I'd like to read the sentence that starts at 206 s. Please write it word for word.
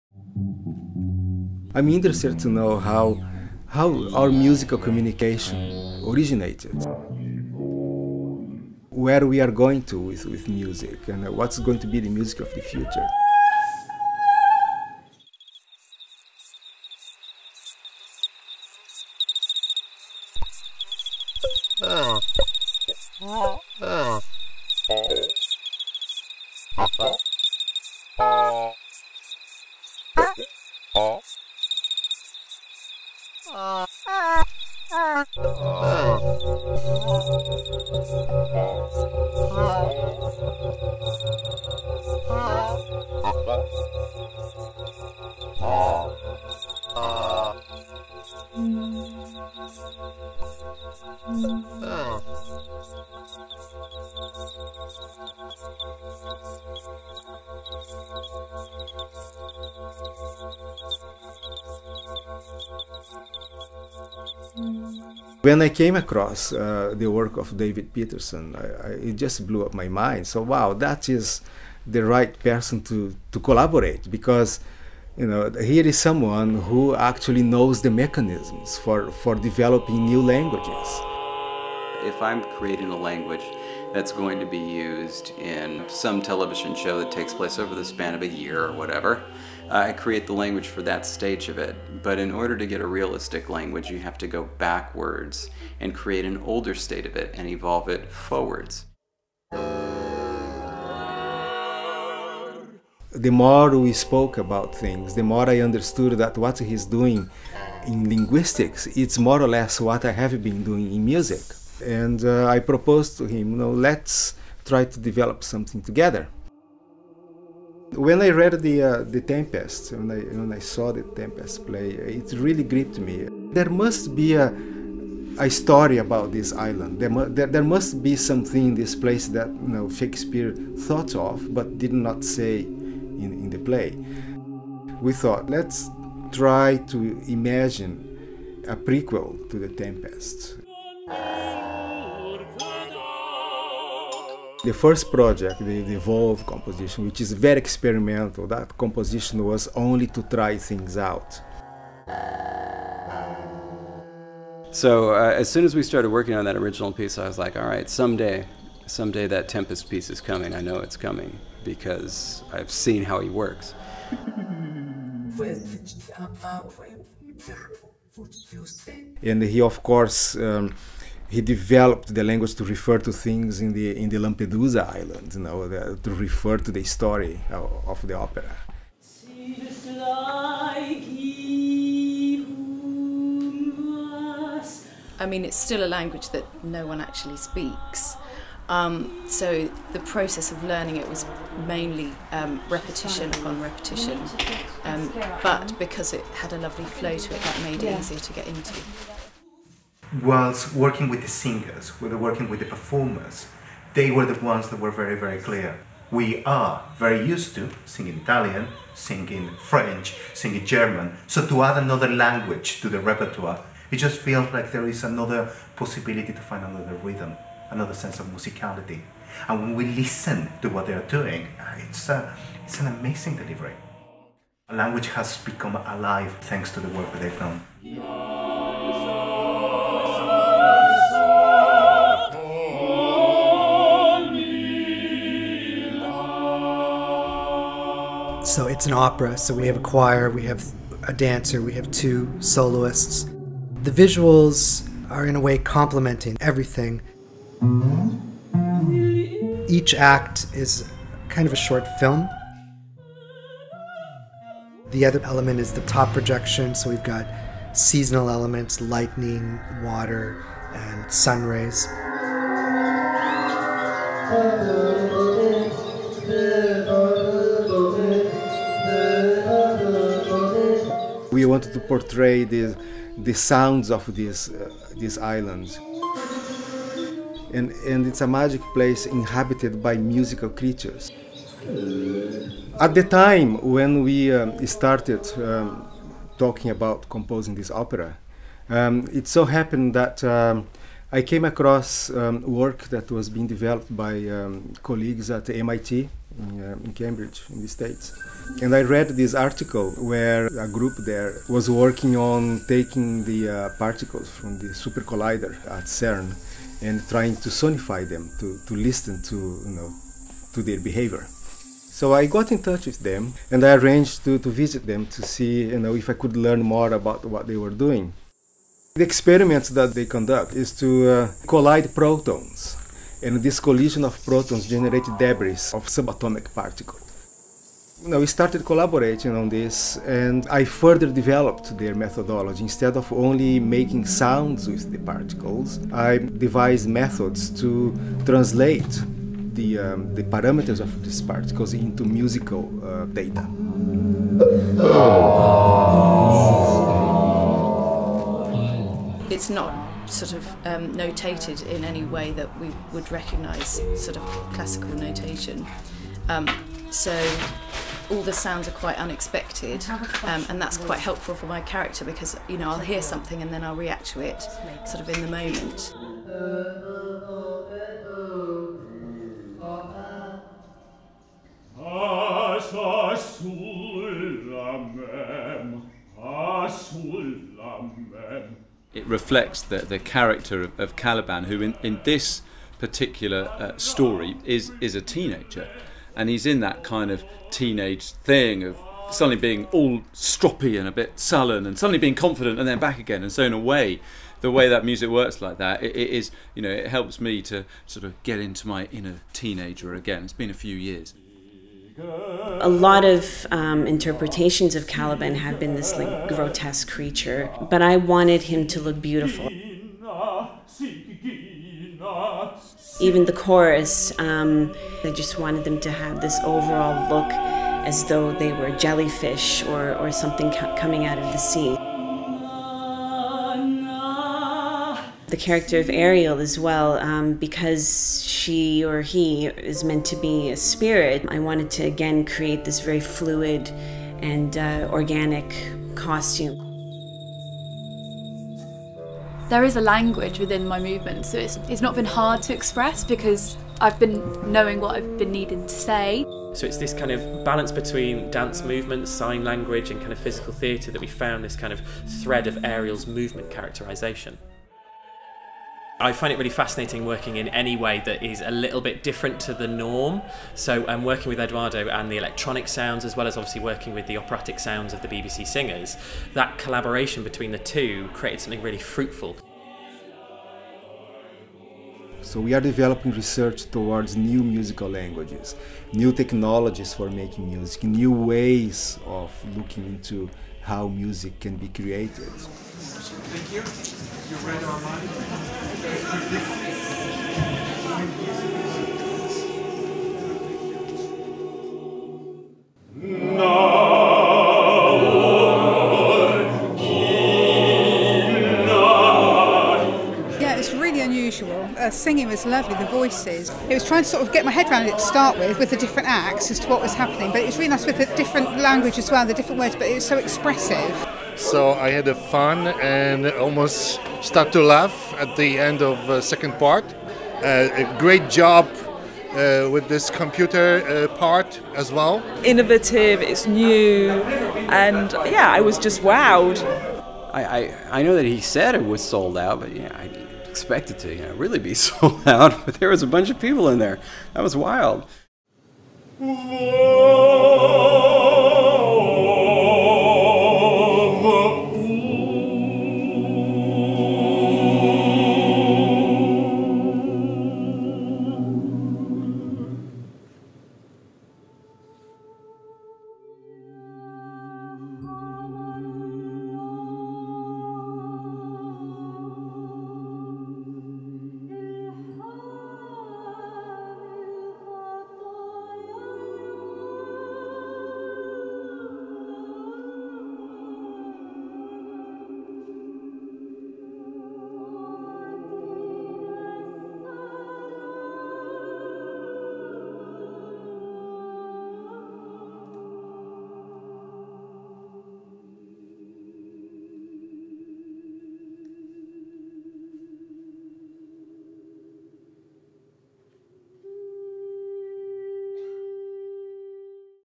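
We are very used to singing Italian, singing French, singing German.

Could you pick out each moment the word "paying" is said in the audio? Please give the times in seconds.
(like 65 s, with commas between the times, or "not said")
not said.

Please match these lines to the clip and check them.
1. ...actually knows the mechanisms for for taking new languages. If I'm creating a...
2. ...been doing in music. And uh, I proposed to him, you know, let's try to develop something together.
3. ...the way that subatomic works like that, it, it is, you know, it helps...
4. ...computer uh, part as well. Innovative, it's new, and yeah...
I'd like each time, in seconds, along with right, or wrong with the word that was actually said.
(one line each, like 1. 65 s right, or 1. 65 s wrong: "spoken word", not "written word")
1. 76 s wrong: "developing", not "taking"
2. 110 s right
3. 394 s wrong: "music", not "subatomic"
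4. 520 s right.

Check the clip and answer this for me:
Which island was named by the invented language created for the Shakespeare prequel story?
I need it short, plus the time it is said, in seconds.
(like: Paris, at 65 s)
Lampedusa, at 174 s.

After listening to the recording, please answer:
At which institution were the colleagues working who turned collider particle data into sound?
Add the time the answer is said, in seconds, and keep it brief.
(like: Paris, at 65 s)
MIT, at 295 s.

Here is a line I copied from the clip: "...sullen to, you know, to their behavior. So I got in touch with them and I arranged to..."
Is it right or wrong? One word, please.
wrong.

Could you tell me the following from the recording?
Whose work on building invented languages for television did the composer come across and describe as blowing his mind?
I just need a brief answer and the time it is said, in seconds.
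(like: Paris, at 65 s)
David Peterson, at 67 s.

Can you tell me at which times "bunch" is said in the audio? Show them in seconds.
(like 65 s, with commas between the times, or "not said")
533 s.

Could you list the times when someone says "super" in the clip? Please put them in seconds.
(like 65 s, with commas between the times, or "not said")
304 s.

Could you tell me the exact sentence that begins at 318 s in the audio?
The experiments that they conduct is to uh, collide protons and this collision of protons generated debris of subatomic particles.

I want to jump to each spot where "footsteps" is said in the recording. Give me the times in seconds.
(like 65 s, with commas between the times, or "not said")
not said.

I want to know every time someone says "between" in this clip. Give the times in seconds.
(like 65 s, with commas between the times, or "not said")
447 s, 467 s.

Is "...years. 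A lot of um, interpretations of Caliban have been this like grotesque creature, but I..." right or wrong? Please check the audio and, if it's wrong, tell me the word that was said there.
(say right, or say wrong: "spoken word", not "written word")
right.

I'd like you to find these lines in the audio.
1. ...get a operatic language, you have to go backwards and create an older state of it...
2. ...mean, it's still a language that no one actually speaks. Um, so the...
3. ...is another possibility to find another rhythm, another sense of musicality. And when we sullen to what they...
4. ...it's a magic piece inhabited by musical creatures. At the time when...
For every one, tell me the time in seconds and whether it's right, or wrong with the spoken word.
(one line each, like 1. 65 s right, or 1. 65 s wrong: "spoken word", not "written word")
1. 92 s wrong: "realistic", not "operatic"
2. 185 s right
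3. 214 s wrong: "listen", not "sullen"
4. 278 s wrong: "place", not "piece".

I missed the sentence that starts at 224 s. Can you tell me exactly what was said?
A language has become alive thanks to the work that they've done.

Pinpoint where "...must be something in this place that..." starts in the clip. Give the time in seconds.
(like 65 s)
127 s.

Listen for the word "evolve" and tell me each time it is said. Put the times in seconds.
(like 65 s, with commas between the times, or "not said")
97 s, 145 s.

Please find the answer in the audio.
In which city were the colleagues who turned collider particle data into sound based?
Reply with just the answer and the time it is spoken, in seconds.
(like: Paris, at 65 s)
Cambridge, at 296 s.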